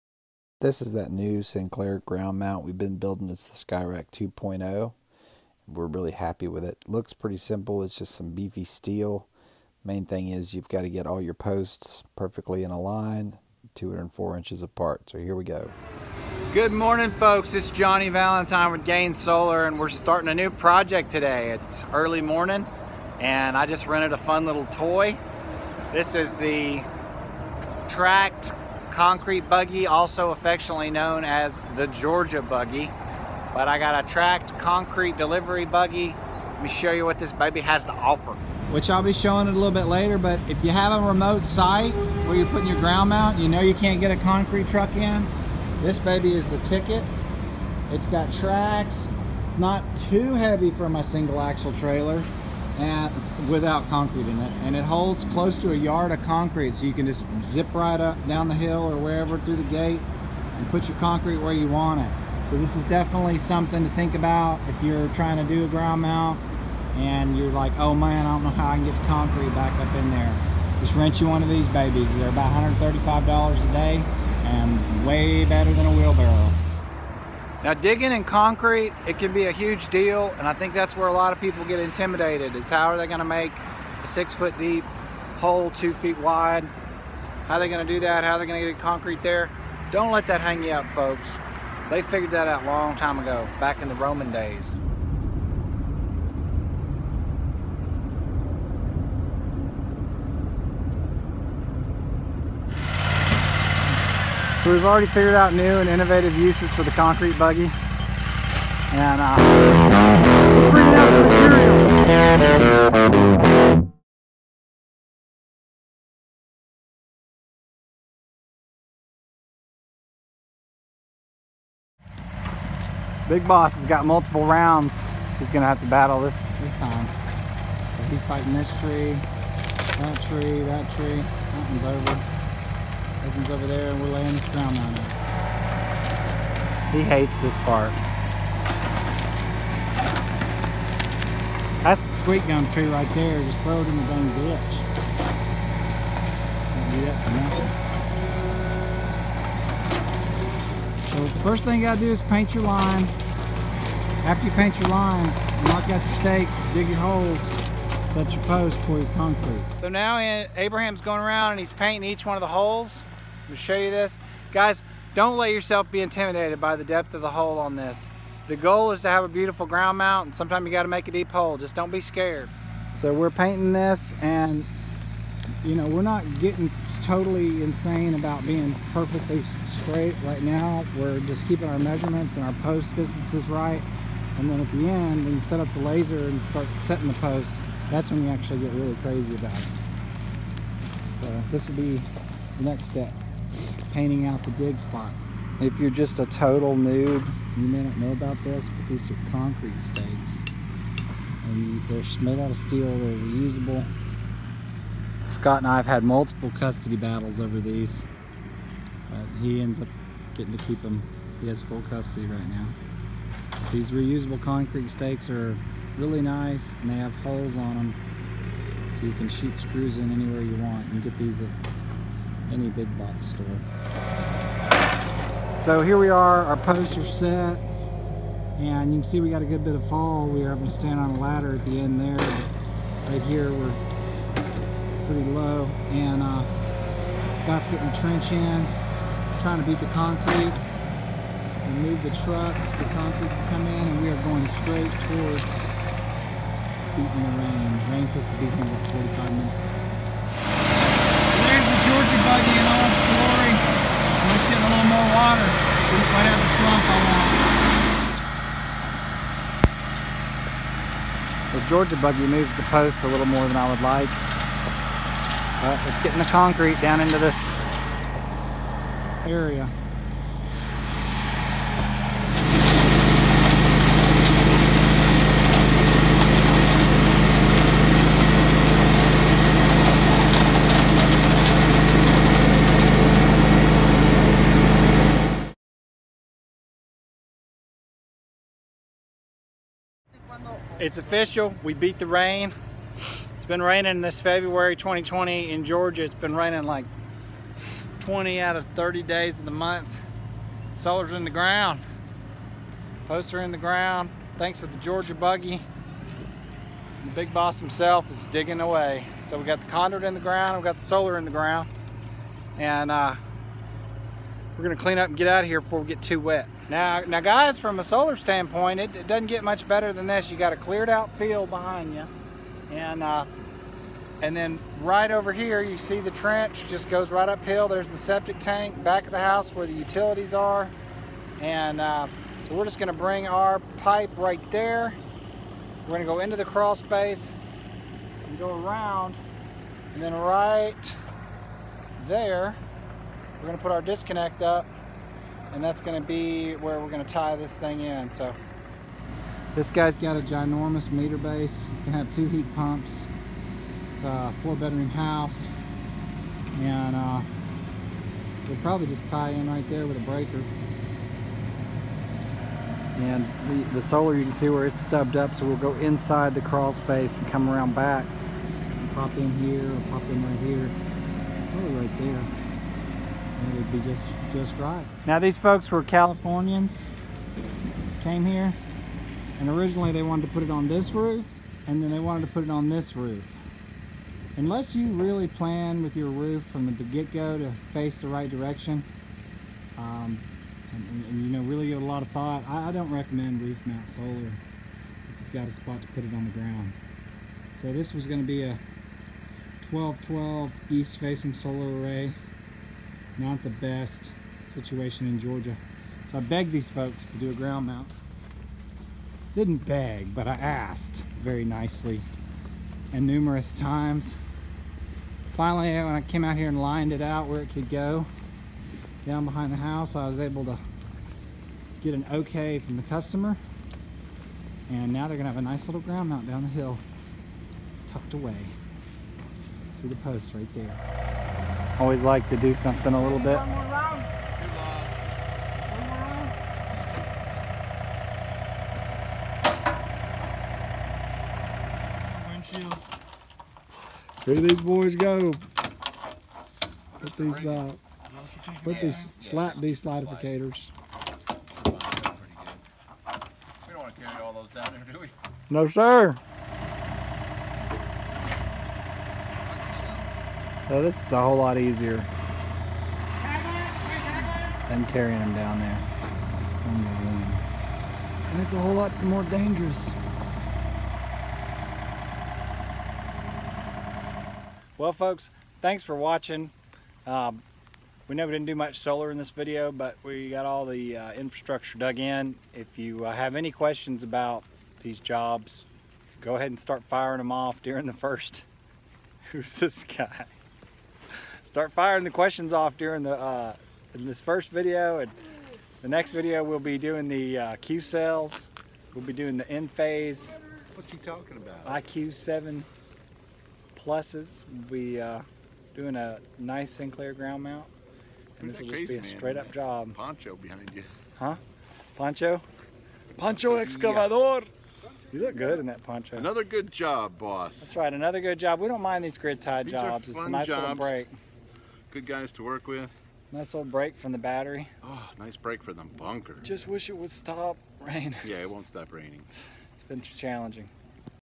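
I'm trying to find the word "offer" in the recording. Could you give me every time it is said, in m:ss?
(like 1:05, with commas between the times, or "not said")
0:37.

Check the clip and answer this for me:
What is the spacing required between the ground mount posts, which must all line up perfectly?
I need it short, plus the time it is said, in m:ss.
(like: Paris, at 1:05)
204 inches, at 0:13.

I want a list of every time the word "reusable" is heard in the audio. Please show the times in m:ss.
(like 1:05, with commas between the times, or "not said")
3:23, 3:33.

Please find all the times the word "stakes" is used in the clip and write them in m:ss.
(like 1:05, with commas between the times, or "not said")
2:36, 3:19, 3:34.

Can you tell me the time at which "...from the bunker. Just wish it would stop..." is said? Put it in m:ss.
8:45.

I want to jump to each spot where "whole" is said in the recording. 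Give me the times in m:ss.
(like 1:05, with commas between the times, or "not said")
7:41, 7:48.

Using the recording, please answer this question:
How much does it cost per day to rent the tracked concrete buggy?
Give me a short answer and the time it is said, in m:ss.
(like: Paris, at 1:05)
$135, at 1:12.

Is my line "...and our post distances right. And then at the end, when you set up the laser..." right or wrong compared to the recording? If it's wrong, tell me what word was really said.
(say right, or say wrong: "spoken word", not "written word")
right.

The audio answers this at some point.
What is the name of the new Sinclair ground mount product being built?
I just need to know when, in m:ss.
0:03.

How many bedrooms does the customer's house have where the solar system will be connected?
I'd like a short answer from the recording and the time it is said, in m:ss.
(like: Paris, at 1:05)
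4, at 5:54.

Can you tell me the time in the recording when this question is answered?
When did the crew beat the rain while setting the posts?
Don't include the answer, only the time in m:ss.
4:54.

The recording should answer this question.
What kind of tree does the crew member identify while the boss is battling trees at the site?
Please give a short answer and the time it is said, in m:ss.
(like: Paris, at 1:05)
Sweet gum, at 2:22.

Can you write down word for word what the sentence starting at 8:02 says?
If you uh, have any questions about these jobs, go ahead and start firing them off during the first.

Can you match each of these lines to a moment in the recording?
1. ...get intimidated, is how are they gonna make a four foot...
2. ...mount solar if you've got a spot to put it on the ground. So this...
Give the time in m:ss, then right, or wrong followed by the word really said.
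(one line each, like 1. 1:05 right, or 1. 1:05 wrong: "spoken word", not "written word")
1. 1:21 wrong: "six", not "four"
2. 6:33 right.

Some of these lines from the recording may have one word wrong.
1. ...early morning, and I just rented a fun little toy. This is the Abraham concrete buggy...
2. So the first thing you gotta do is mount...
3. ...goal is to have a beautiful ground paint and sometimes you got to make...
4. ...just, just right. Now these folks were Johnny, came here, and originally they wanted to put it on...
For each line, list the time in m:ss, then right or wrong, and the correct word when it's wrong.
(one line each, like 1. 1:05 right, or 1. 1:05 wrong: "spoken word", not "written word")
1. 0:21 wrong: "Tract", not "Abraham"
2. 2:31 wrong: "paint", not "mount"
3. 2:48 wrong: "mount", not "paint"
4. 6:13 wrong: "Californians", not "Johnny".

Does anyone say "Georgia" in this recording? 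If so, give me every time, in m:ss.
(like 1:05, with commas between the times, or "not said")
0:31, 4:21, 4:55, 5:04, 6:45.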